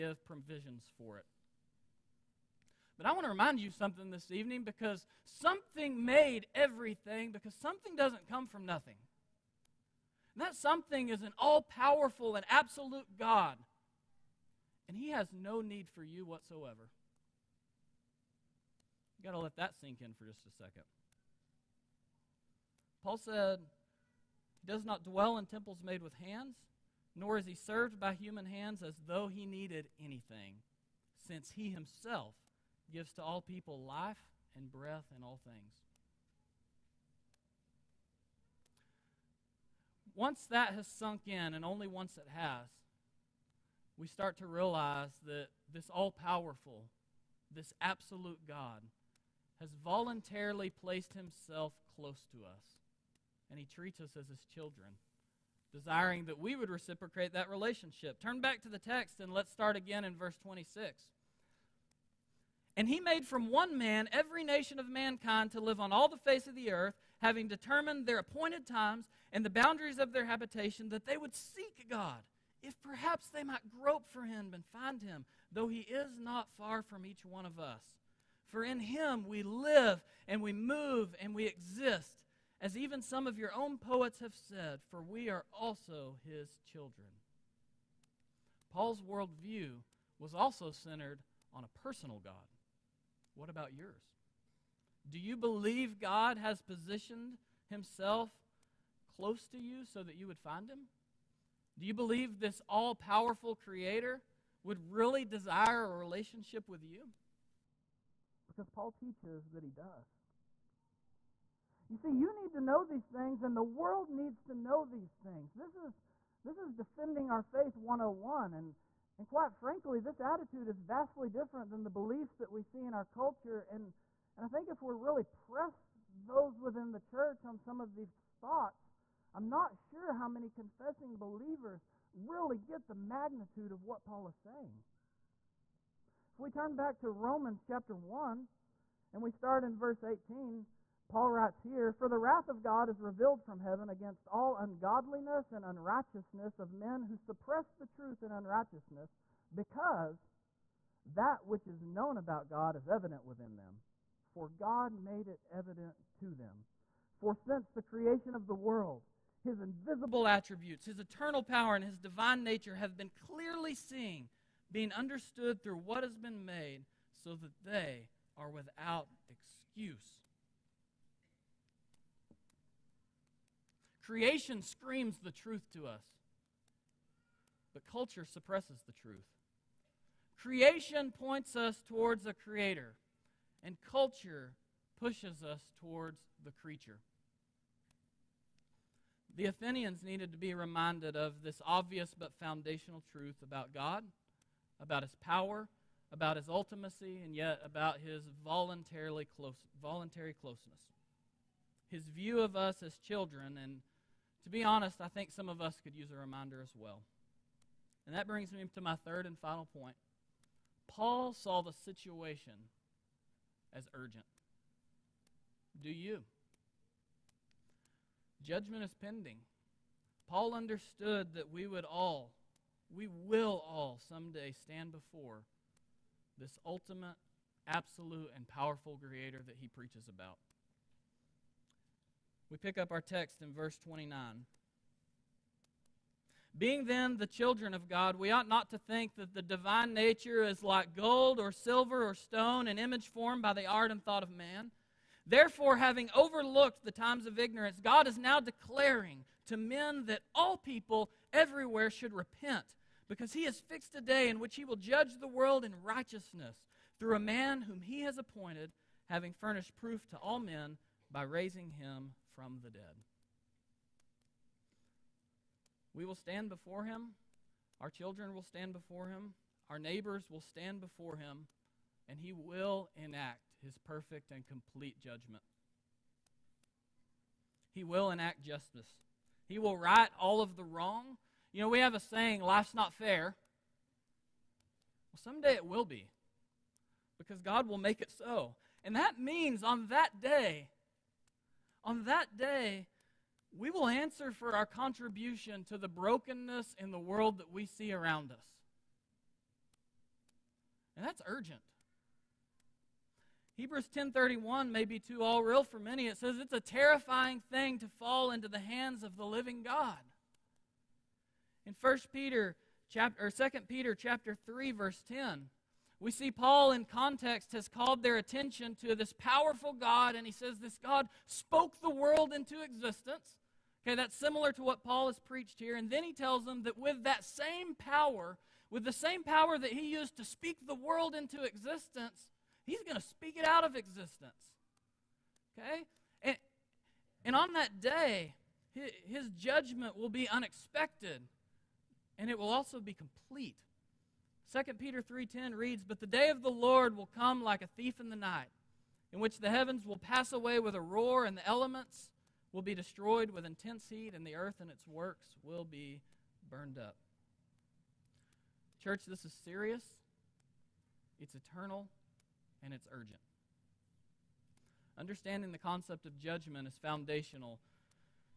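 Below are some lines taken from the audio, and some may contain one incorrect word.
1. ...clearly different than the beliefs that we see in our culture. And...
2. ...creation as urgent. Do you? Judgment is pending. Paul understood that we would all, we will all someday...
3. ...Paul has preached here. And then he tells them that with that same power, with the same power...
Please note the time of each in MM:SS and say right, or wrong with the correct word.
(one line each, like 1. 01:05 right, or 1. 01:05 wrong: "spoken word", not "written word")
1. 02:00 wrong: "vastly", not "clearly"
2. 03:31 wrong: "situation", not "creation"
3. 05:24 right.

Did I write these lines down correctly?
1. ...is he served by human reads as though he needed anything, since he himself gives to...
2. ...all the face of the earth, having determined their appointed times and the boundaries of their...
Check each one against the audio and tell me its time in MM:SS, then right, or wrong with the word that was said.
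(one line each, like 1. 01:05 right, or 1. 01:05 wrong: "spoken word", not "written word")
1. 00:27 wrong: "hands", not "reads"
2. 01:05 right.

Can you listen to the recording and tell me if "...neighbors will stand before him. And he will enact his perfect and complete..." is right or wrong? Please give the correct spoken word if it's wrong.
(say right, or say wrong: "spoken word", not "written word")
right.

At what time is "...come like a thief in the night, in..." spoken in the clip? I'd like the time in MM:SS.
05:47.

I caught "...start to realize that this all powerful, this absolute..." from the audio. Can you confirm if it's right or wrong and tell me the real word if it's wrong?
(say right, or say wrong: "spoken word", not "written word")
right.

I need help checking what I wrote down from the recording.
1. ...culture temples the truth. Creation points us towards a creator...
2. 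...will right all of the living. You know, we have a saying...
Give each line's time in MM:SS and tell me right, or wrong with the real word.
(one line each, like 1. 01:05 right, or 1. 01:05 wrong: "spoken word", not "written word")
1. 02:57 wrong: "suppresses", not "temples"
2. 04:39 wrong: "wrong", not "living".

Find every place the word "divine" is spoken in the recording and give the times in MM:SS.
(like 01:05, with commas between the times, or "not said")
02:41, 03:59.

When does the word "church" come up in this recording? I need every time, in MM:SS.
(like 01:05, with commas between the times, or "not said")
02:07, 05:58.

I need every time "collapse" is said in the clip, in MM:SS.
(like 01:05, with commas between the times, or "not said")
not said.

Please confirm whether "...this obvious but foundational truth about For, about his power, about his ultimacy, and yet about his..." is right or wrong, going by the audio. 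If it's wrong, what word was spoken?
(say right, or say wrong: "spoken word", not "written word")
wrong: "God", not "For".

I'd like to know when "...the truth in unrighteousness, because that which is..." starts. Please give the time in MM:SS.
02:27.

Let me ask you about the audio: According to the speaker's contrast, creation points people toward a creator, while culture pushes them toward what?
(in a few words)
The creature.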